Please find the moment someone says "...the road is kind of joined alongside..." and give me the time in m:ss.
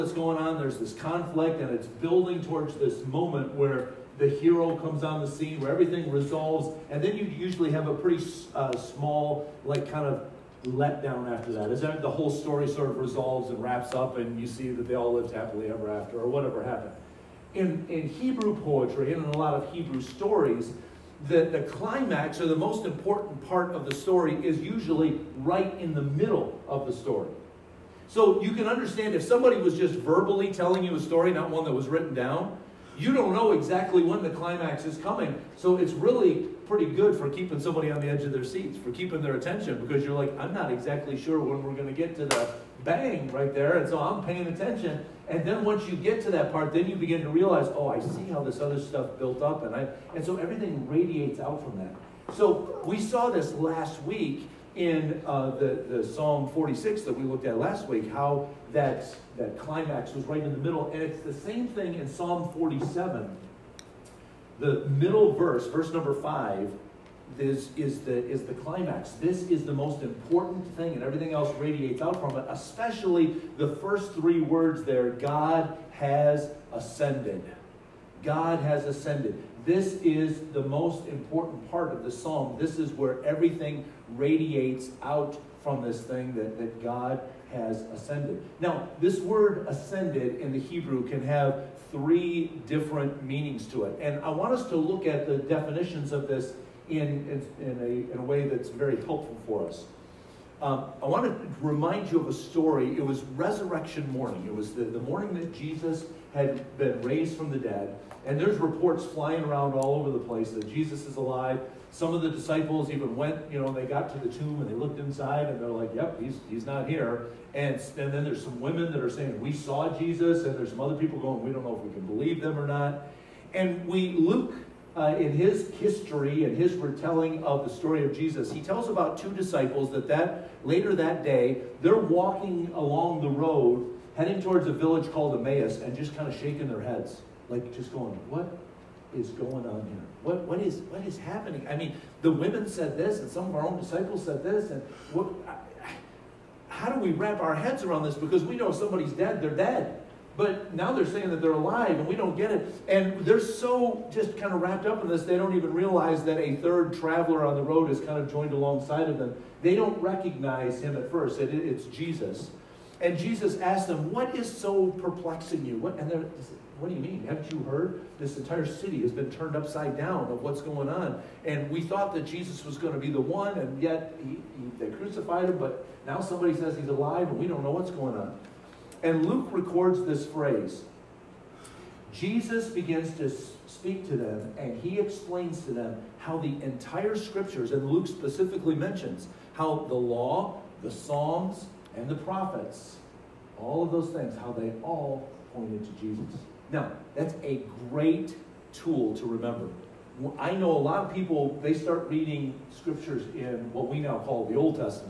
2:37.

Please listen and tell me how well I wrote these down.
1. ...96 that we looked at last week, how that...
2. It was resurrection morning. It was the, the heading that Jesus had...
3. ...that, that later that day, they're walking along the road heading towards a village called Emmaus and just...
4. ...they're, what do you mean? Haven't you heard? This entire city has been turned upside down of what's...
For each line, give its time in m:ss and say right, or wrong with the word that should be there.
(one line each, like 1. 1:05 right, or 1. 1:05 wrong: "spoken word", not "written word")
1. 0:56 wrong: "46", not "96"
2. 1:42 wrong: "morning", not "heading"
3. 2:09 right
4. 2:46 right.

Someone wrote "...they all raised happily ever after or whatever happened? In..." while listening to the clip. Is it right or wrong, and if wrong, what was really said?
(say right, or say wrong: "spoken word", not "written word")
wrong: "lived", not "raised".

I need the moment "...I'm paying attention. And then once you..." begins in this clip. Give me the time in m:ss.
0:43.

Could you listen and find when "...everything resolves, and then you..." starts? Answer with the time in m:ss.
0:05.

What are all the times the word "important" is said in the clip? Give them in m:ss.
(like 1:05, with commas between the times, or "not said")
0:22, 1:10, 1:21.